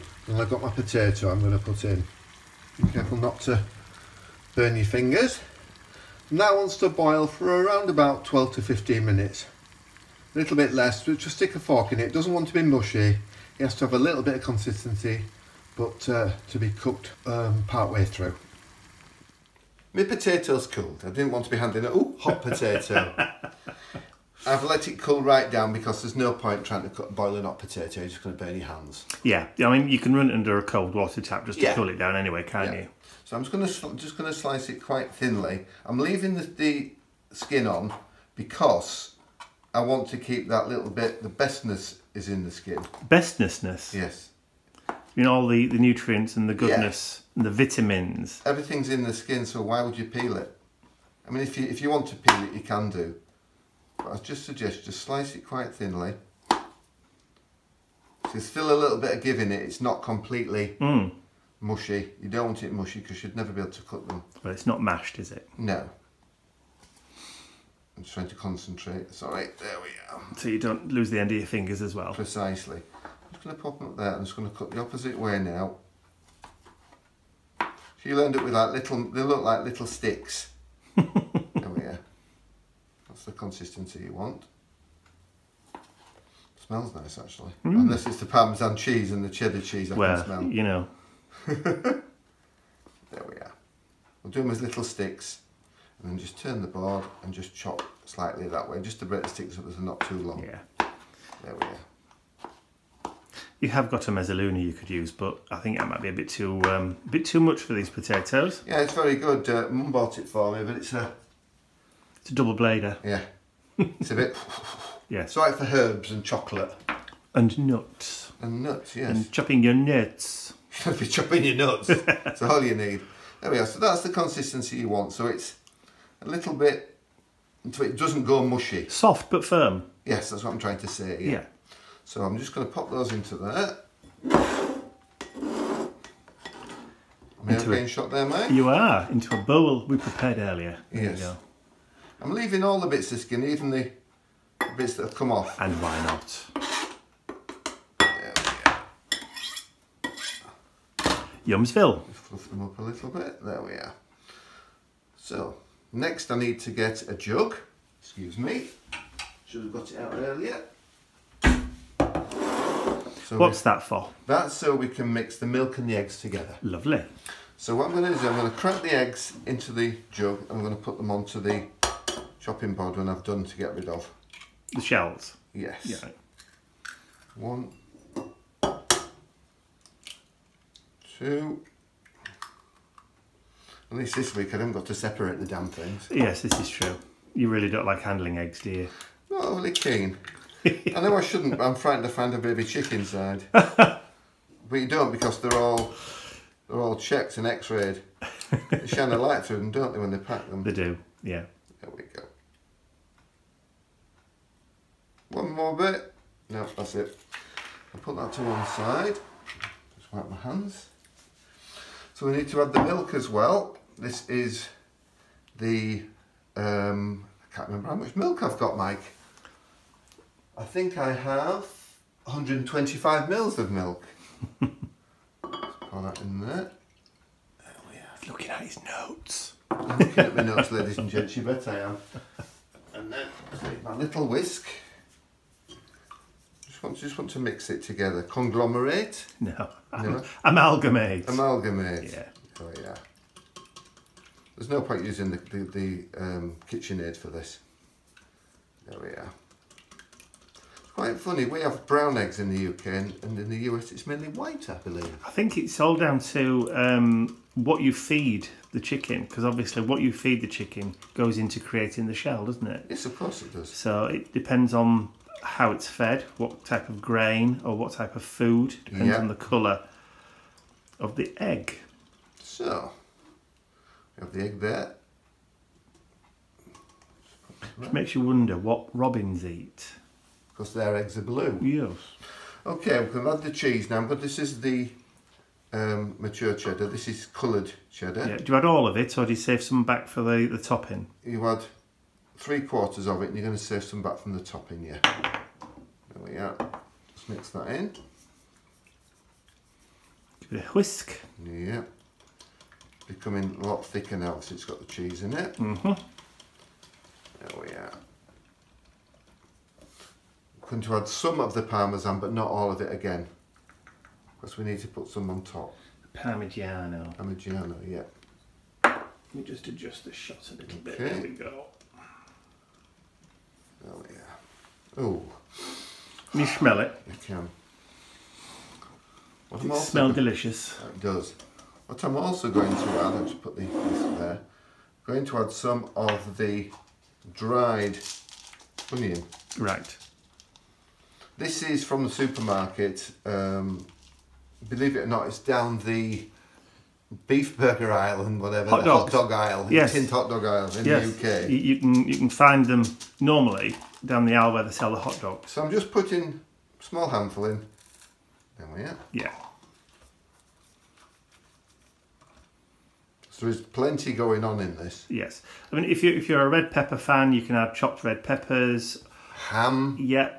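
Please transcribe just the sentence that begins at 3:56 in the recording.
Just want, just want to mix it together.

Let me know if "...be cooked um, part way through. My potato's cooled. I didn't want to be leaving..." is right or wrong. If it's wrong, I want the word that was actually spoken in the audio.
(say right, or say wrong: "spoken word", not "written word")
wrong: "handing", not "leaving".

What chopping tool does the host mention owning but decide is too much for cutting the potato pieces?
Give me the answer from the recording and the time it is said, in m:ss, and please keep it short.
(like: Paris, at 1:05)
mezzaluna, at 1:44.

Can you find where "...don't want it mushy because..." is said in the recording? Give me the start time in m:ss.
1:02.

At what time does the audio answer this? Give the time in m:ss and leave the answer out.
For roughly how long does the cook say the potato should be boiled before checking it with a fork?
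0:08.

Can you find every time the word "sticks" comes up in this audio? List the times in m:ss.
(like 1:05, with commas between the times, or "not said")
0:11, 1:19, 1:34, 1:39.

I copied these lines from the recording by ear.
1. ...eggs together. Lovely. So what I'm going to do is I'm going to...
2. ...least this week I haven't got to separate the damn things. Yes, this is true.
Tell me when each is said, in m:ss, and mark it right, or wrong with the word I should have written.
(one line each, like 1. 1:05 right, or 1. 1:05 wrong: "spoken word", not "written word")
1. 2:45 right
2. 3:03 right.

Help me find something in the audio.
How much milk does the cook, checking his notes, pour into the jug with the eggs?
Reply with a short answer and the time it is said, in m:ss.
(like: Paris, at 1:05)
125 ml, at 3:42.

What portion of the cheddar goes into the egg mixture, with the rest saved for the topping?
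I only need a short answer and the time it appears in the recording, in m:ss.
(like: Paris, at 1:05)
three quarters, at 4:52.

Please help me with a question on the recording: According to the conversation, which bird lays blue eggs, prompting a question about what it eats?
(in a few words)
robins.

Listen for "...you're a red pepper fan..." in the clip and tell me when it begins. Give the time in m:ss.
6:06.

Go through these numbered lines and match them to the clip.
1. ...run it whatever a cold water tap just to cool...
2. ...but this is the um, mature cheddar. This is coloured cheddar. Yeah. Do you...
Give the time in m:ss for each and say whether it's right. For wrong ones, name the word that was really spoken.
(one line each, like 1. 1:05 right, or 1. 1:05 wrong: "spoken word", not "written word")
1. 0:30 wrong: "under", not "whatever"
2. 4:44 right.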